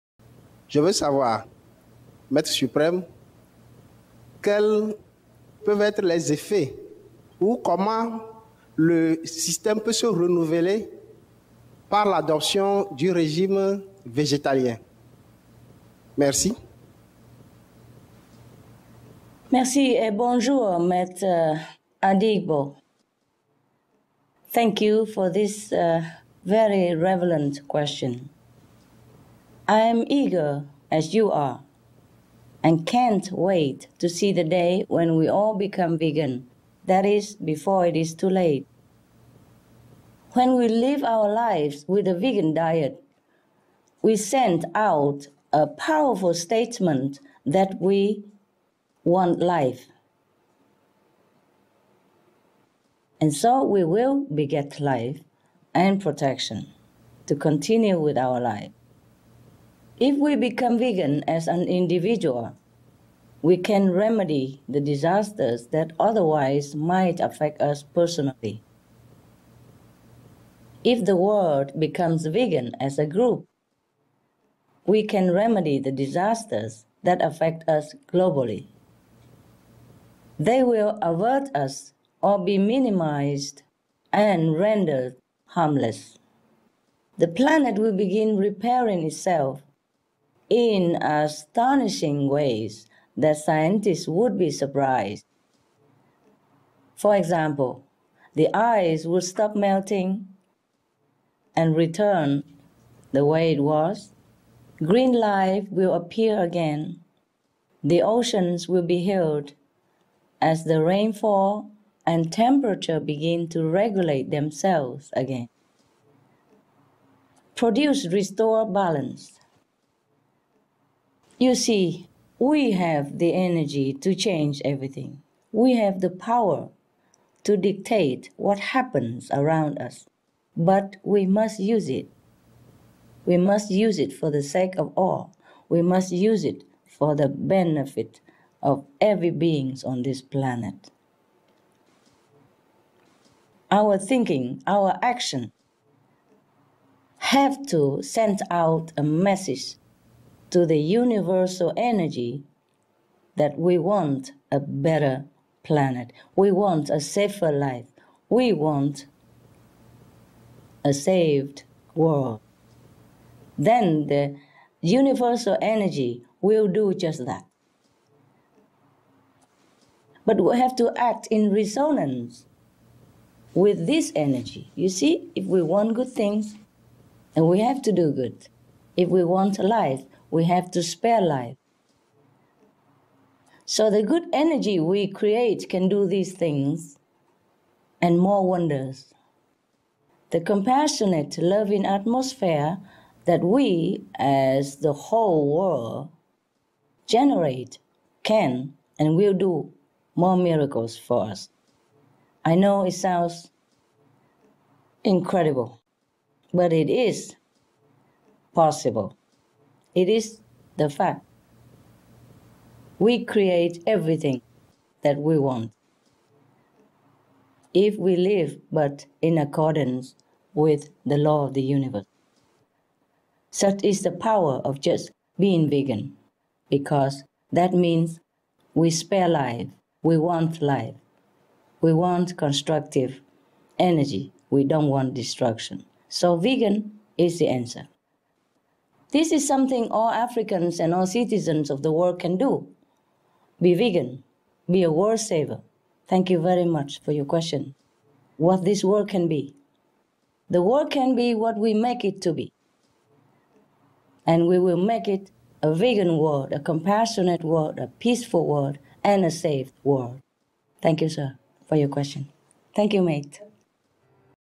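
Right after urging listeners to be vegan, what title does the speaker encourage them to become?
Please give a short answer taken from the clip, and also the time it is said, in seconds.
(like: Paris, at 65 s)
a world saver, at 244 s.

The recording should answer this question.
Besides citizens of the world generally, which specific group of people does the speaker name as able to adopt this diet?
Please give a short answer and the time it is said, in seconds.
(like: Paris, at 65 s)
all Africans, at 239 s.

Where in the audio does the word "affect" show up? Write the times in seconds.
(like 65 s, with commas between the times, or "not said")
67 s, 77 s.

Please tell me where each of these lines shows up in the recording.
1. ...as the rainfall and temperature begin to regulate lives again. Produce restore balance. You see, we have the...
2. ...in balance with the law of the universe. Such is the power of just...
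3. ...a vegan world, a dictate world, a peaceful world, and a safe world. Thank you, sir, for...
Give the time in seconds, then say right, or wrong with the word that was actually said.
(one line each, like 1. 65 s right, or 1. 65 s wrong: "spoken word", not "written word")
1. 110 s wrong: "themselves", not "lives"
2. 219 s wrong: "accordance", not "balance"
3. 255 s wrong: "compassionate", not "dictate".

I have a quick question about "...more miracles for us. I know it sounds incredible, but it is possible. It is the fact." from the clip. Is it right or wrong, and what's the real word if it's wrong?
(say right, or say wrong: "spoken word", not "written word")
right.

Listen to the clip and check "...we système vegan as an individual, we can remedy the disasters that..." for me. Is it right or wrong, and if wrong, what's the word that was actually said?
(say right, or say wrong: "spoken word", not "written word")
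wrong: "become", not "système".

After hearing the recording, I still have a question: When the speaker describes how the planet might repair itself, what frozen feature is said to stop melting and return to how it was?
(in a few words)
the ice.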